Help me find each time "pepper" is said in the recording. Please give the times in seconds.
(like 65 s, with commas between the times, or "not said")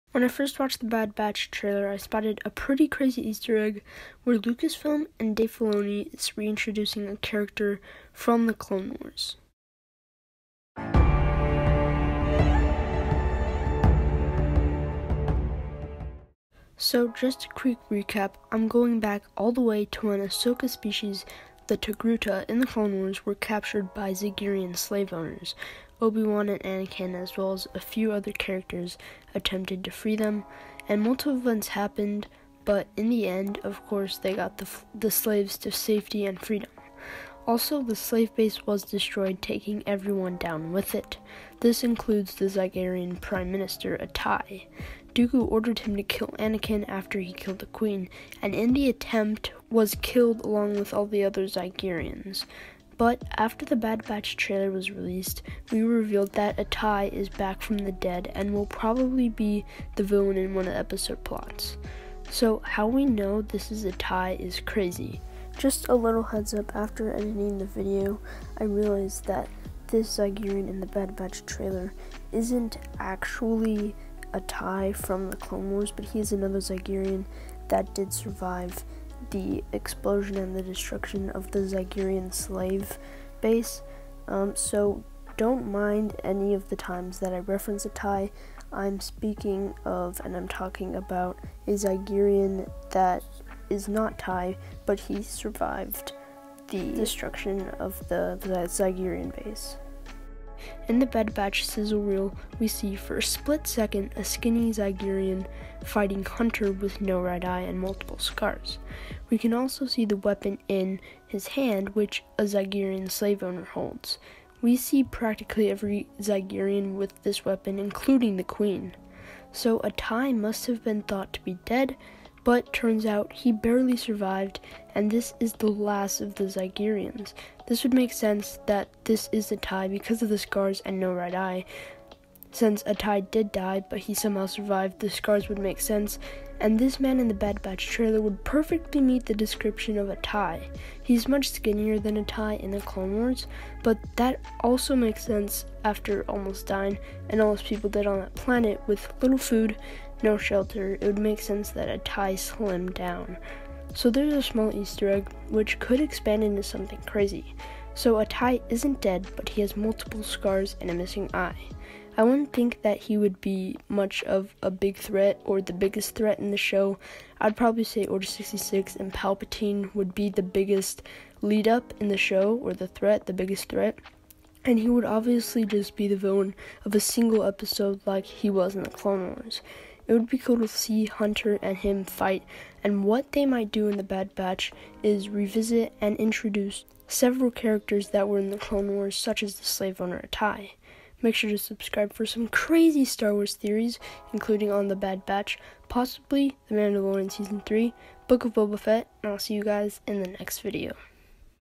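not said.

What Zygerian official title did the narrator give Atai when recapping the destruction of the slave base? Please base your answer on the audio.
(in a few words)
Prime Minister.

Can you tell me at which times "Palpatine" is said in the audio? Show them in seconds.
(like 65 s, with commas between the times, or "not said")
169 s.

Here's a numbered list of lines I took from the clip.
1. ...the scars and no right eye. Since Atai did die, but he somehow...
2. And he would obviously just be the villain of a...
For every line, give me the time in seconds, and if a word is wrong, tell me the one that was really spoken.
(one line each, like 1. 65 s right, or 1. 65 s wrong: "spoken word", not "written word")
1. 130 s right
2. 174 s right.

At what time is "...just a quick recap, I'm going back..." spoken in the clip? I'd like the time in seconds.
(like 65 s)
17 s.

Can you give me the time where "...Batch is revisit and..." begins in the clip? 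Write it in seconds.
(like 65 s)
184 s.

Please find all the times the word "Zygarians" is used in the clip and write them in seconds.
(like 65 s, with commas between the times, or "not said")
51 s.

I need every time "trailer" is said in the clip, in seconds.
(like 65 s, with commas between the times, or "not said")
1 s, 54 s, 71 s, 137 s.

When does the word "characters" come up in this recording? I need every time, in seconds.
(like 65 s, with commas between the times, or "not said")
7 s, 28 s, 187 s.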